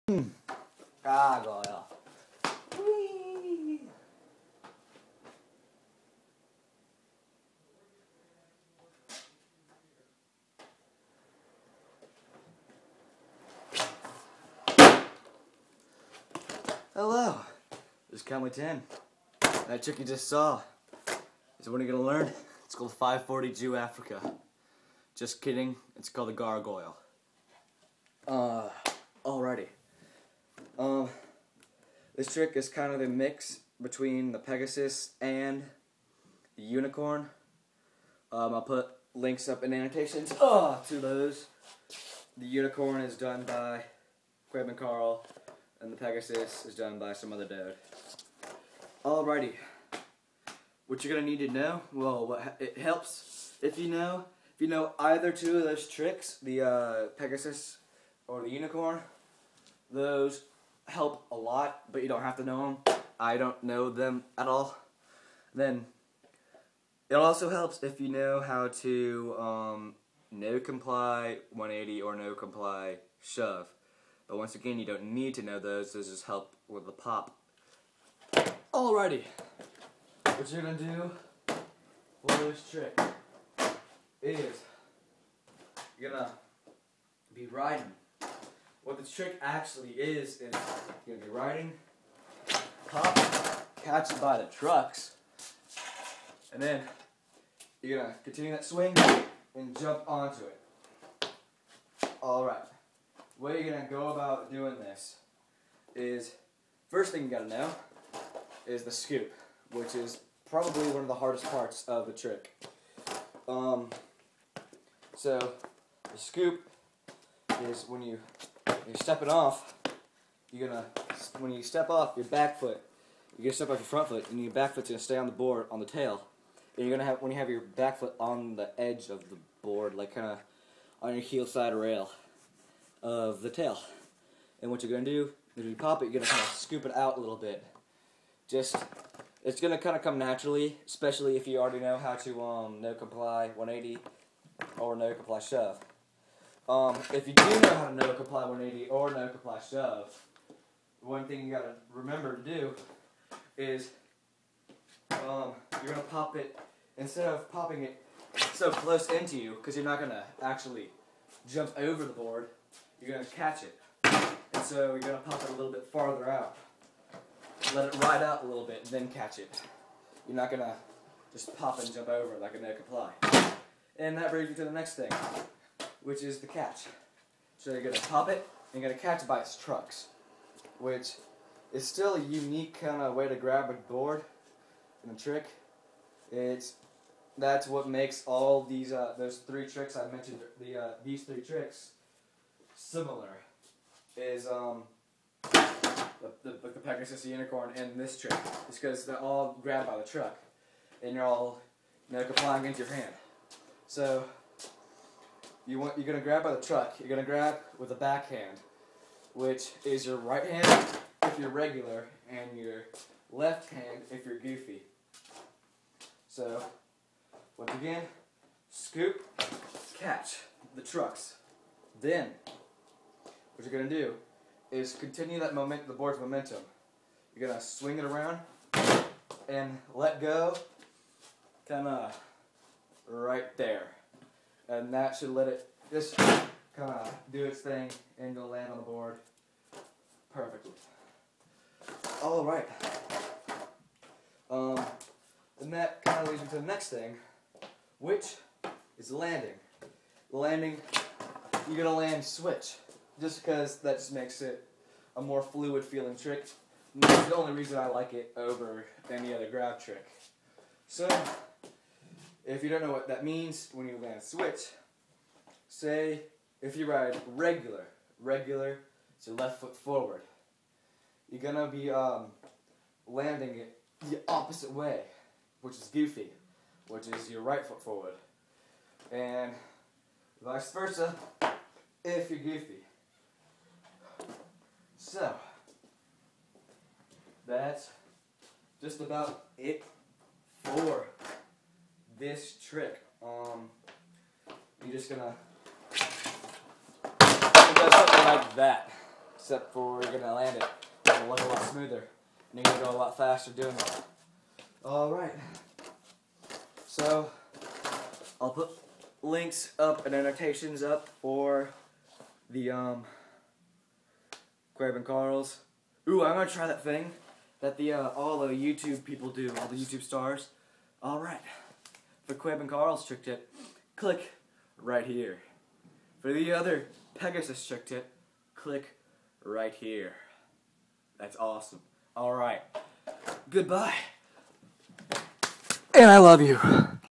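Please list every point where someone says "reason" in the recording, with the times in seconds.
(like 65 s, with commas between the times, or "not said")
257 s.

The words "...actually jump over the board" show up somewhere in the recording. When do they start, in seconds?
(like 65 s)
160 s.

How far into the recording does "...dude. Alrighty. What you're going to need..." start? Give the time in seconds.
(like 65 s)
47 s.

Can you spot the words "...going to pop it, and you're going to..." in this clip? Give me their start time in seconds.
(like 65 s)
177 s.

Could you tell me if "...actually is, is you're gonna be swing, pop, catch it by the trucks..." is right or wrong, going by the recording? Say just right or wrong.
wrong.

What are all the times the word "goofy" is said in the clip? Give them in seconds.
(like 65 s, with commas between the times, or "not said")
214 s, 275 s, 282 s.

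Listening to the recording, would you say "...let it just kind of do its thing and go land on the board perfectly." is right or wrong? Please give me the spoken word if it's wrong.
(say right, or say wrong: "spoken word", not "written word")
right.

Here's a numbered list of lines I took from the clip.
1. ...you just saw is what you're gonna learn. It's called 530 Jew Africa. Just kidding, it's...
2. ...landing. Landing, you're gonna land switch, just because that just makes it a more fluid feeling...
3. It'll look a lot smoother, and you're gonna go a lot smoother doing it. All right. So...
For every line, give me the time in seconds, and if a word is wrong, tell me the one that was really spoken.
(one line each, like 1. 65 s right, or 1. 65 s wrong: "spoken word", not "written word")
1. 19 s wrong: "540", not "530"
2. 249 s right
3. 301 s wrong: "faster", not "smoother".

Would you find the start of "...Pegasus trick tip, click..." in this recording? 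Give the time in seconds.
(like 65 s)
327 s.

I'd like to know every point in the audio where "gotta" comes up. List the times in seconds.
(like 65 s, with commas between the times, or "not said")
107 s, 151 s.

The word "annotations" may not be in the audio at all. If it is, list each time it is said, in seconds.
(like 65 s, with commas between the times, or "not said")
39 s, 310 s.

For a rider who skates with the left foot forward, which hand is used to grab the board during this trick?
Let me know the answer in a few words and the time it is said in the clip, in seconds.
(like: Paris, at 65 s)
Right hand, at 210 s.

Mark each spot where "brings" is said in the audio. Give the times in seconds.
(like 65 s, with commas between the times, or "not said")
174 s.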